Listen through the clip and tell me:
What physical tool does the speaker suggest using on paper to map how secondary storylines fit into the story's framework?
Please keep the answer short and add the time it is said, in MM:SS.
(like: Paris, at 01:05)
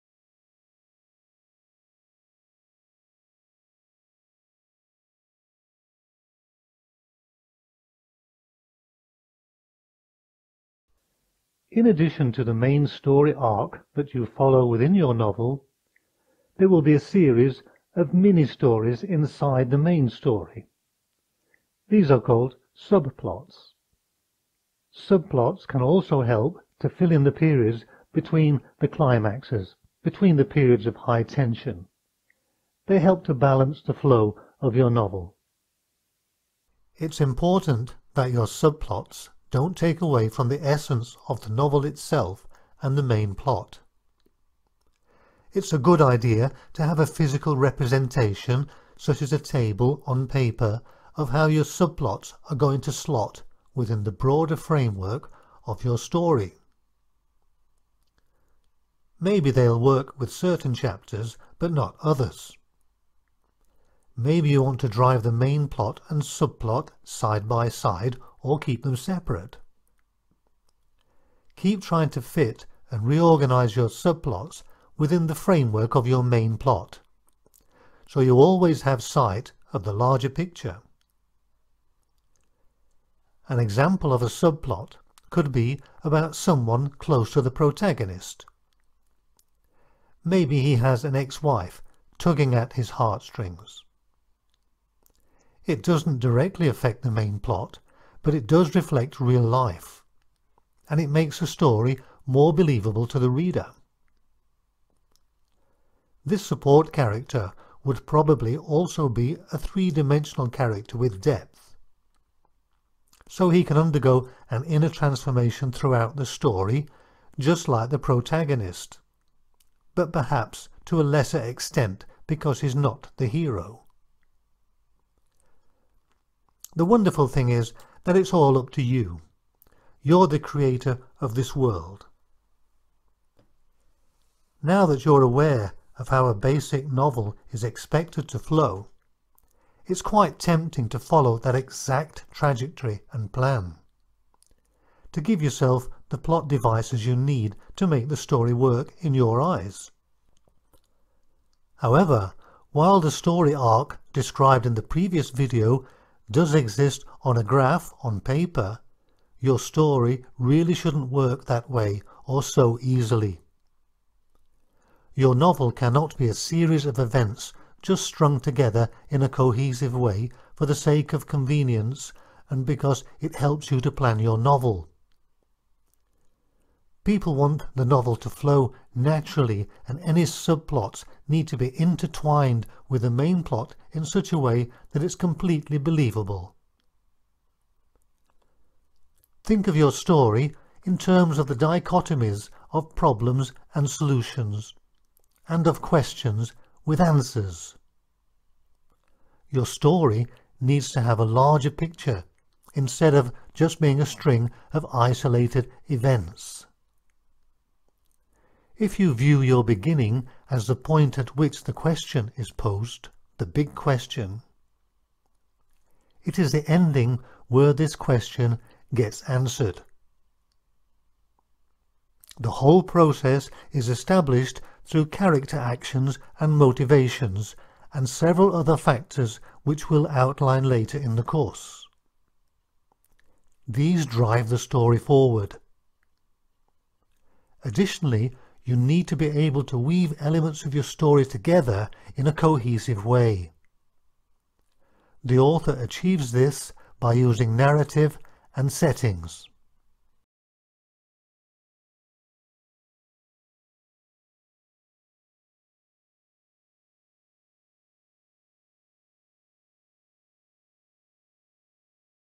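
A table, at 00:49.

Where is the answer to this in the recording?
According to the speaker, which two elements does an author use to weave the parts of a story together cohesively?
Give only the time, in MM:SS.
04:07.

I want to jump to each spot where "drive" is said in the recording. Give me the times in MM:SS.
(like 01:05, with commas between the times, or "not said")
01:04, 03:54.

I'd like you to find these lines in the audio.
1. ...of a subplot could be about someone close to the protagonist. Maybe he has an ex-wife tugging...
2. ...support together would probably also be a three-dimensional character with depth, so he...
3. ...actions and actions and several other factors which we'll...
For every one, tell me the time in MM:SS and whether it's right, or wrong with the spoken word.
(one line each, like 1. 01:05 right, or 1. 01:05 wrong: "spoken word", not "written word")
1. 01:24 right
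2. 01:46 wrong: "character", not "together"
3. 03:45 wrong: "motivations", not "actions".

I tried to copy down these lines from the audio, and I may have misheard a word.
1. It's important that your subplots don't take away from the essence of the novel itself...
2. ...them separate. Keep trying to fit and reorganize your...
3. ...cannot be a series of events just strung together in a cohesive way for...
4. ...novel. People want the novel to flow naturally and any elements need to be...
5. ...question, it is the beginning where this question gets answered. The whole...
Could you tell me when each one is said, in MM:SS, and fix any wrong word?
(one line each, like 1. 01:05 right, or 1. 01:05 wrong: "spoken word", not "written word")
1. 00:36 right
2. 01:08 right
3. 02:45 right
4. 02:54 wrong: "subplots", not "elements"
5. 03:33 wrong: "ending", not "beginning".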